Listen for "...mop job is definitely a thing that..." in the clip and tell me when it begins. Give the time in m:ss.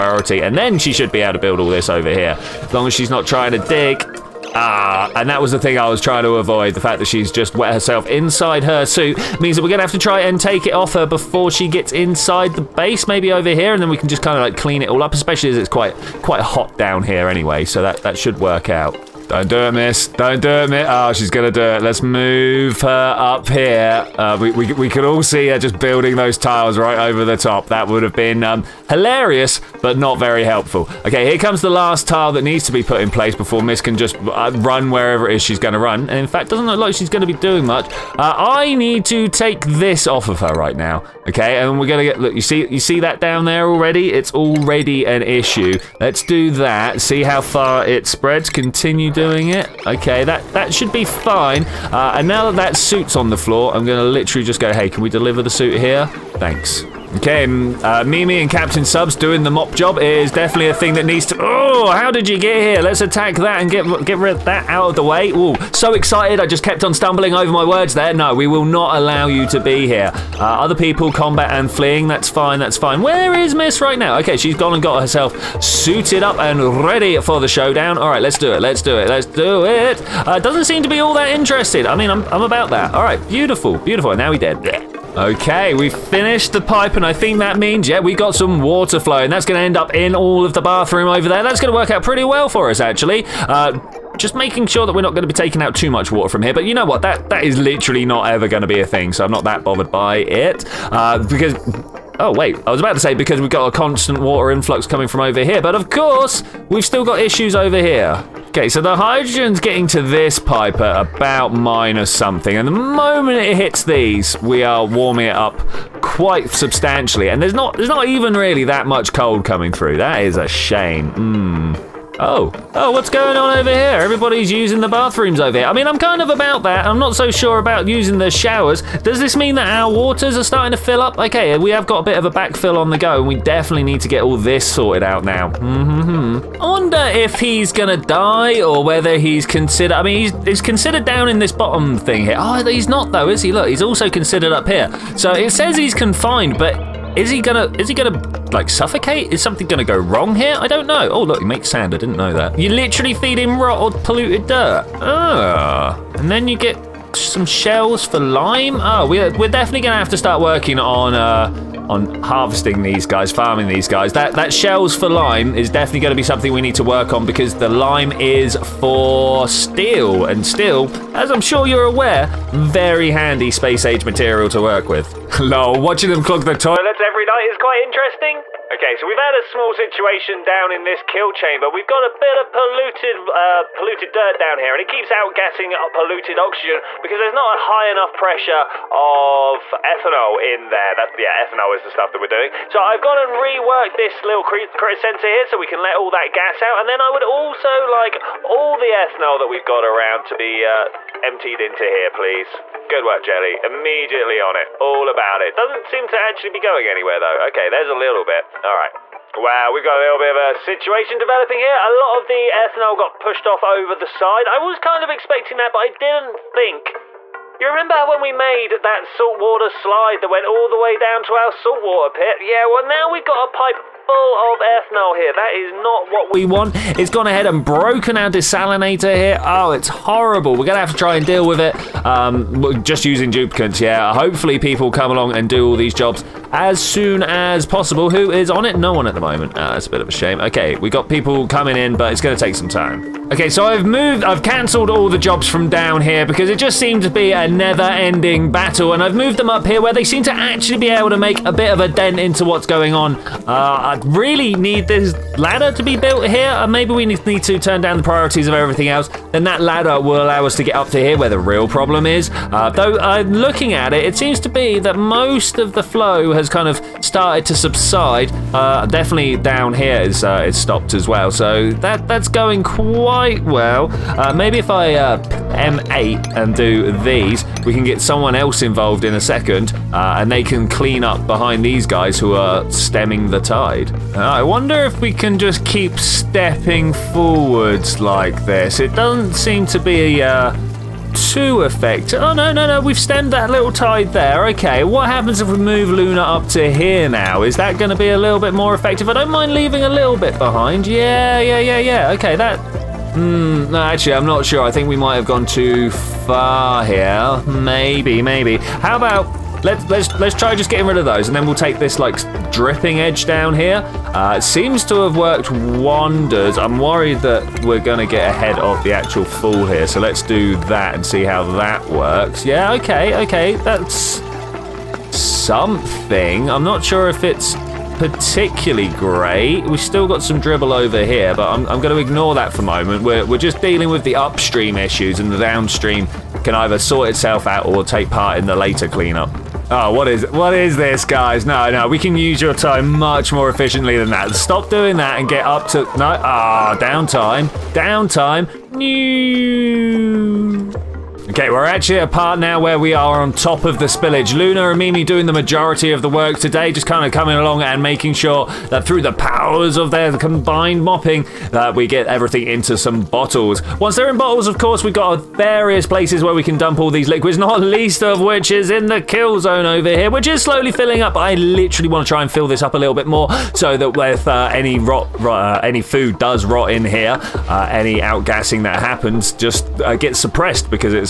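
0:59.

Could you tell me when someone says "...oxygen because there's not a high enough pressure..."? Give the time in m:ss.
3:06.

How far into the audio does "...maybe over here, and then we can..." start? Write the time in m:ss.
0:13.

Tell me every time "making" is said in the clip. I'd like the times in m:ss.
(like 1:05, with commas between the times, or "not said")
1:34, 5:57.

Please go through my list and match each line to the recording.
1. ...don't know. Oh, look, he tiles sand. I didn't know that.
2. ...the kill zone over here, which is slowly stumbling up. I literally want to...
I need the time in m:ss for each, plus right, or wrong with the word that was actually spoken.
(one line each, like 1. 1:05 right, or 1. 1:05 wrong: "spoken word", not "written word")
1. 2:30 wrong: "makes", not "tiles"
2. 6:08 wrong: "filling", not "stumbling".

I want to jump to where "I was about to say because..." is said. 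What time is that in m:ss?
1:42.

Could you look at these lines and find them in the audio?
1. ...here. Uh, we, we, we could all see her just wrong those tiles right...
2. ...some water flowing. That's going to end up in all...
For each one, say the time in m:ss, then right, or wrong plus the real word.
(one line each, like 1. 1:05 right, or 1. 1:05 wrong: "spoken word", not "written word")
1. 0:23 wrong: "building", not "wrong"
2. 1:28 right.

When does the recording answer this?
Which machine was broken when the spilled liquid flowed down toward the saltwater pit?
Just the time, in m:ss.
3:48.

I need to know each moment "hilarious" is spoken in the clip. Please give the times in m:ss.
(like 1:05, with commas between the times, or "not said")
0:28.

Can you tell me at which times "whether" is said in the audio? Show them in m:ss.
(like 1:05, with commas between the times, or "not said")
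2:18.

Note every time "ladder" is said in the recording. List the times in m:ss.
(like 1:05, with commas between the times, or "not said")
4:15, 4:19.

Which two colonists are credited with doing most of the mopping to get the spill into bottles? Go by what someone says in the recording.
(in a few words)
Luna and Mimi.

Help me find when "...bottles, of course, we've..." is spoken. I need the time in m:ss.
6:04.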